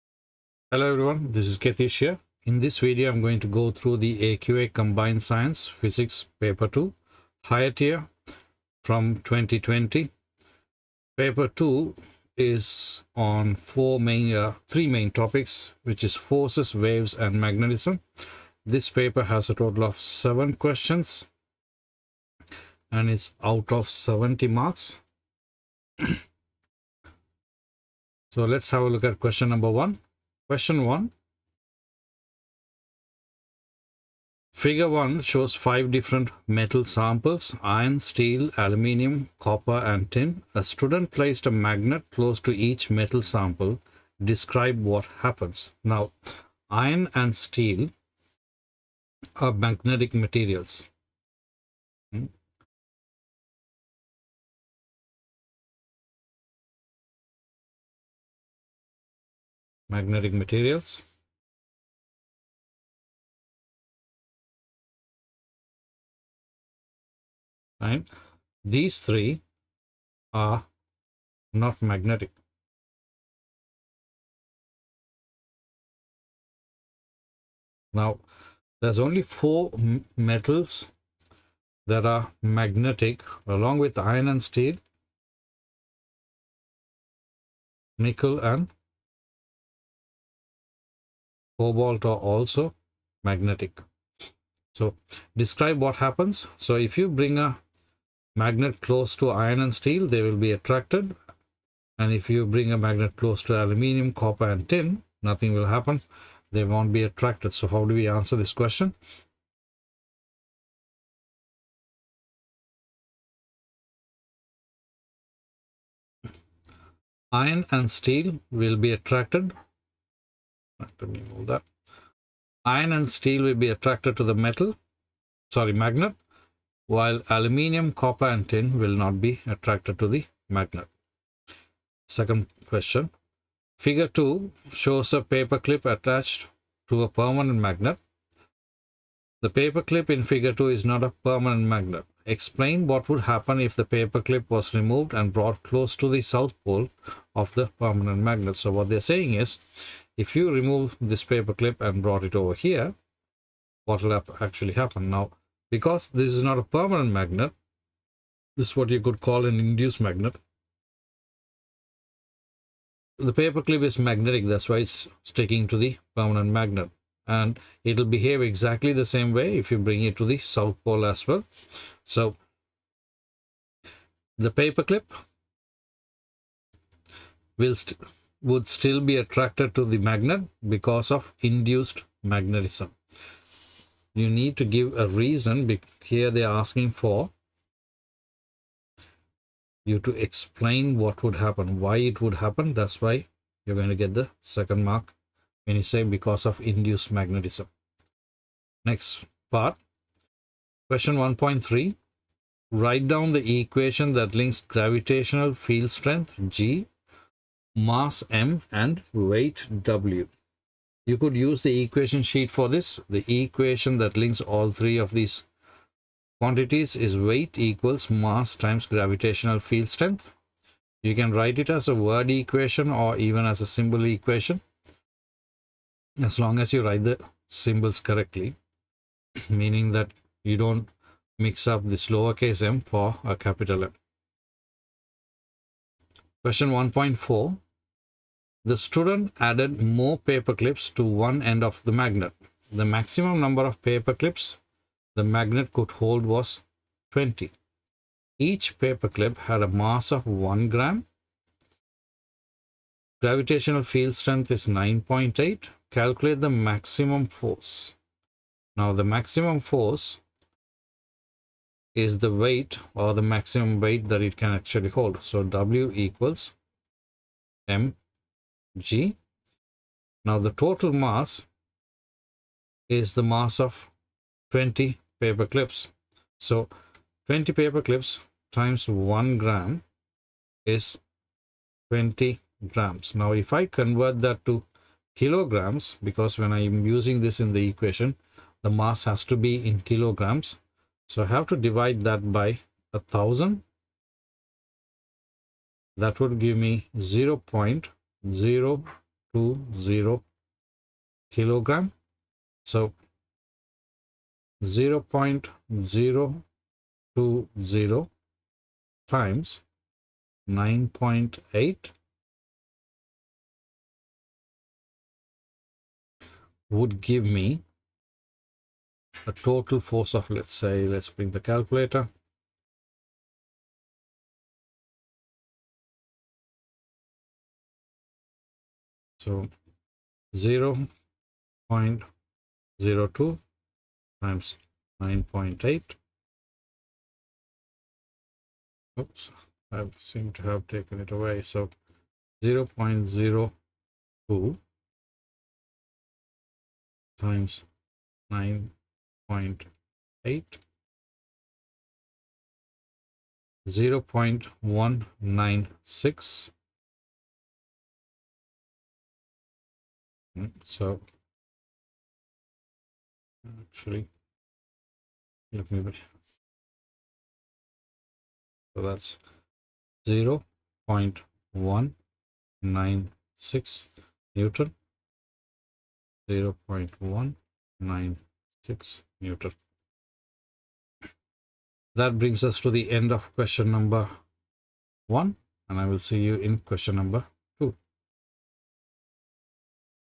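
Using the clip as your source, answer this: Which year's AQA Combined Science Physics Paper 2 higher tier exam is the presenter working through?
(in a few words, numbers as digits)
2020.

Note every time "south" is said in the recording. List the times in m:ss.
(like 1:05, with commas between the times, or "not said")
2:26, 2:50.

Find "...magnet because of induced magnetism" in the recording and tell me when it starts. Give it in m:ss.
2:59.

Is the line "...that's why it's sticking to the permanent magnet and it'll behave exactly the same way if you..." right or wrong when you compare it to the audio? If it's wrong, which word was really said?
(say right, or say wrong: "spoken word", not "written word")
right.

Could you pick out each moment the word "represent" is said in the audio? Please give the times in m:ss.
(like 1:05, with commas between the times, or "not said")
not said.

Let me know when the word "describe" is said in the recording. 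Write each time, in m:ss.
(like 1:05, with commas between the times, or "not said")
0:44, 1:35.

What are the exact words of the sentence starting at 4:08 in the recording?
Each paper clip had a mass of 1 gram.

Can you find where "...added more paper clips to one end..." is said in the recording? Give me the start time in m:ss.
3:59.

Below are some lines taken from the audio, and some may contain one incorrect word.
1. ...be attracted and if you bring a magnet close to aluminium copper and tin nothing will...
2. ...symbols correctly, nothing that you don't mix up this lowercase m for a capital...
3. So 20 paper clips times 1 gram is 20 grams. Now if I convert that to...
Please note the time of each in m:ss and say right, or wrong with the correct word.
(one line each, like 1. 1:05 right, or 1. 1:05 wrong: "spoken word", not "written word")
1. 1:40 right
2. 3:47 wrong: "meaning", not "nothing"
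3. 4:36 right.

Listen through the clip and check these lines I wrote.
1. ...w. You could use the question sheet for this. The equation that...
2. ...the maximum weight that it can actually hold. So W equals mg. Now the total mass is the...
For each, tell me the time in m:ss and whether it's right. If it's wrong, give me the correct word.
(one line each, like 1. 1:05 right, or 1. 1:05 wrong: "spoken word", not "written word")
1. 3:29 wrong: "equation", not "question"
2. 4:23 right.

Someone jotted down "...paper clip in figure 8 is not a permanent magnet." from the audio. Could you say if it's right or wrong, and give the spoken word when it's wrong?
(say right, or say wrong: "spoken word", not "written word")
wrong: "2", not "8".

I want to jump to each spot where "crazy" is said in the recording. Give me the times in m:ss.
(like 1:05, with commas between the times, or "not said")
not said.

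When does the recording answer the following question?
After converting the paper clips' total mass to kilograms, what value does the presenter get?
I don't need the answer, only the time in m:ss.
4:57.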